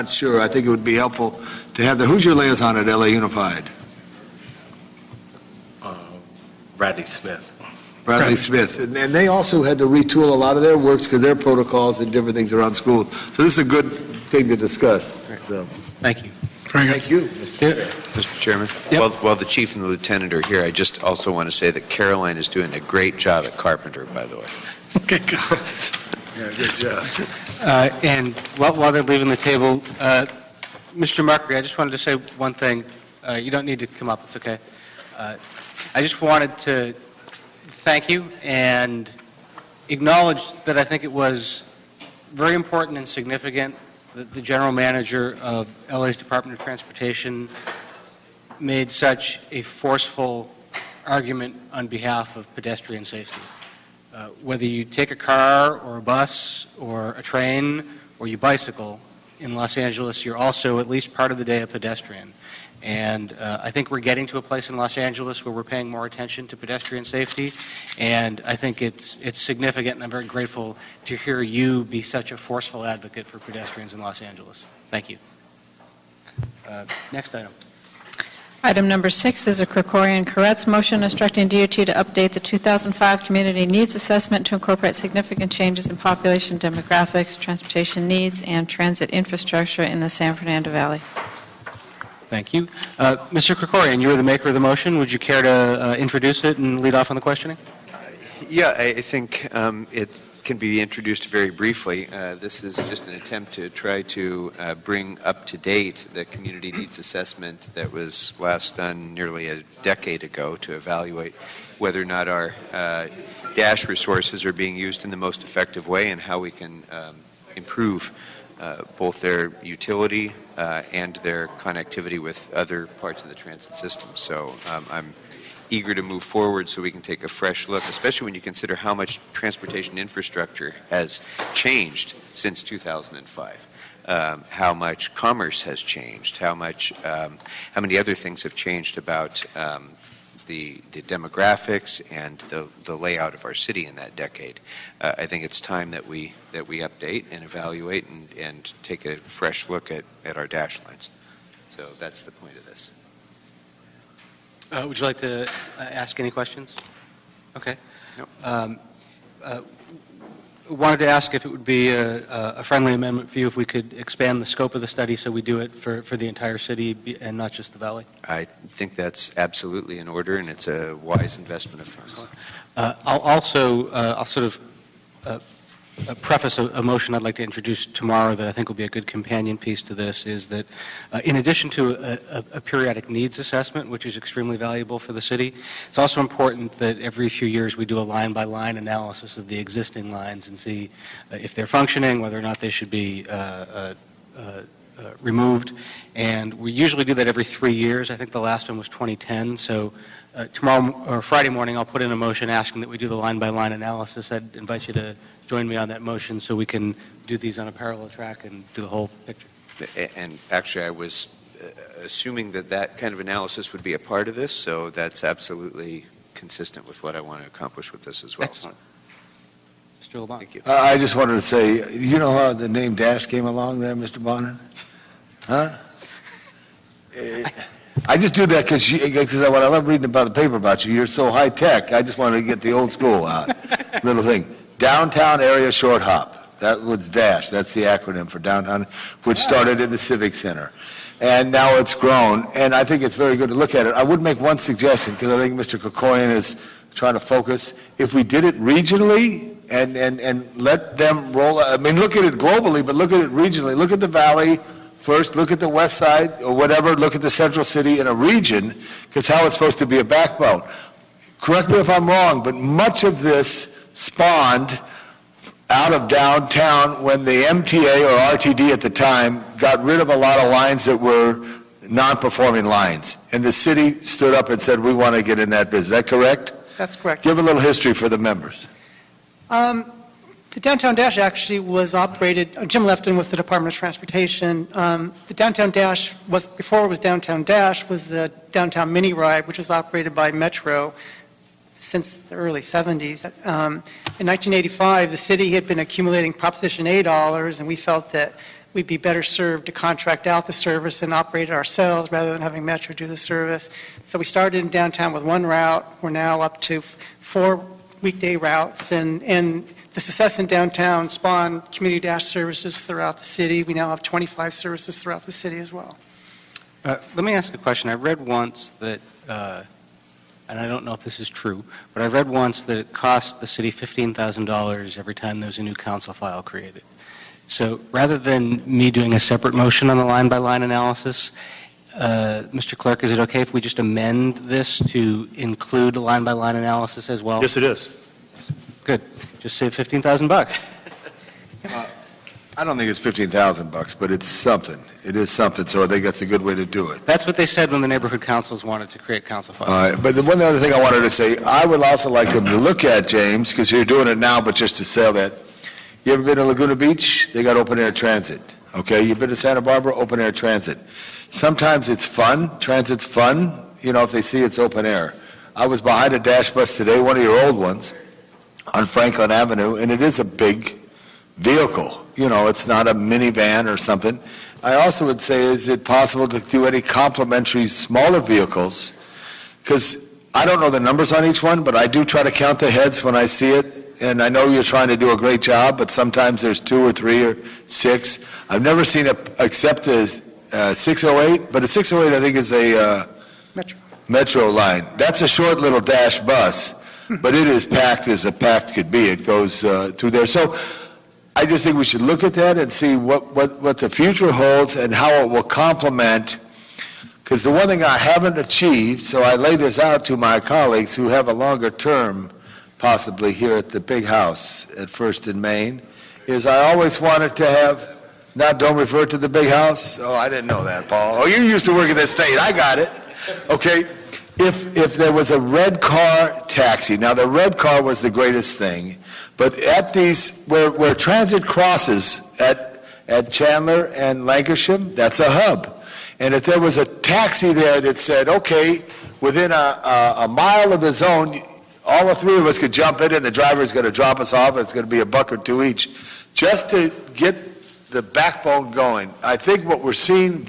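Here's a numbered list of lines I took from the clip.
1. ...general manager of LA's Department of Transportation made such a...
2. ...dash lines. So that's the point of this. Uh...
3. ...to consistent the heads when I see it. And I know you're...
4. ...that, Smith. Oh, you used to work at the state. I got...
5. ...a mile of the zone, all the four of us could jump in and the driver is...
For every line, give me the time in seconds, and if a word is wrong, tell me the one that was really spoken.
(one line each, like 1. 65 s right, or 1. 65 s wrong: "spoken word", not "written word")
1. 44 s right
2. 150 s right
3. 382 s wrong: "count", not "consistent"
4. 420 s wrong: "Paul", not "Smith"
5. 440 s wrong: "three", not "four".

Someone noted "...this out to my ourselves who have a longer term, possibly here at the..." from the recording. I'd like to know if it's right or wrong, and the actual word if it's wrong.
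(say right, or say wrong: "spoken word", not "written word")
wrong: "colleagues", not "ourselves".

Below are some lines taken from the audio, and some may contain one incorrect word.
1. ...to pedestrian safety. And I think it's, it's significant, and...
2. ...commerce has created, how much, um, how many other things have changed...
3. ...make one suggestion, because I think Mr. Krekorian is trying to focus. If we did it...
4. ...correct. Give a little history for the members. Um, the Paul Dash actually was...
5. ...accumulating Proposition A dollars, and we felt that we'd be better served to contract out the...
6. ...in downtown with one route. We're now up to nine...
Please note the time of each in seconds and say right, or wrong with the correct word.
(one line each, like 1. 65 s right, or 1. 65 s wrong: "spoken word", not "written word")
1. 66 s right
2. 135 s wrong: "changed", not "created"
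3. 244 s right
4. 276 s wrong: "Downtown", not "Paul"
5. 295 s right
6. 304 s wrong: "four", not "nine".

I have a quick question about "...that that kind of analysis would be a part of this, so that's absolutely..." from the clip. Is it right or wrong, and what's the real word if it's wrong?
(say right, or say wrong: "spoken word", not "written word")
right.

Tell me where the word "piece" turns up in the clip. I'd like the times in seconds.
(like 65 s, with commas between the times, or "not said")
179 s.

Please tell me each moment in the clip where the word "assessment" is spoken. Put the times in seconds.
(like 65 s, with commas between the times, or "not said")
83 s, 106 s, 183 s.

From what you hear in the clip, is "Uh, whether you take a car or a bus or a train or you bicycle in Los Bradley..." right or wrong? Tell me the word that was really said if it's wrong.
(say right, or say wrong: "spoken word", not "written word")
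wrong: "Angeles", not "Bradley".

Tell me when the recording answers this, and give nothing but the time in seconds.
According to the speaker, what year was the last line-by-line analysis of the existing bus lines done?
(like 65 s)
198 s.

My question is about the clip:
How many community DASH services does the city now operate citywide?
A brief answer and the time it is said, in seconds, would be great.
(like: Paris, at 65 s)
25, at 314 s.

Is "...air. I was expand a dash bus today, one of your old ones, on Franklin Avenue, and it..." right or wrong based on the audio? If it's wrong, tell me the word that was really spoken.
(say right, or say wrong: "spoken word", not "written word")
wrong: "behind", not "expand".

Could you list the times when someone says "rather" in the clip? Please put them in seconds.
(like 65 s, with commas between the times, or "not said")
302 s, 327 s.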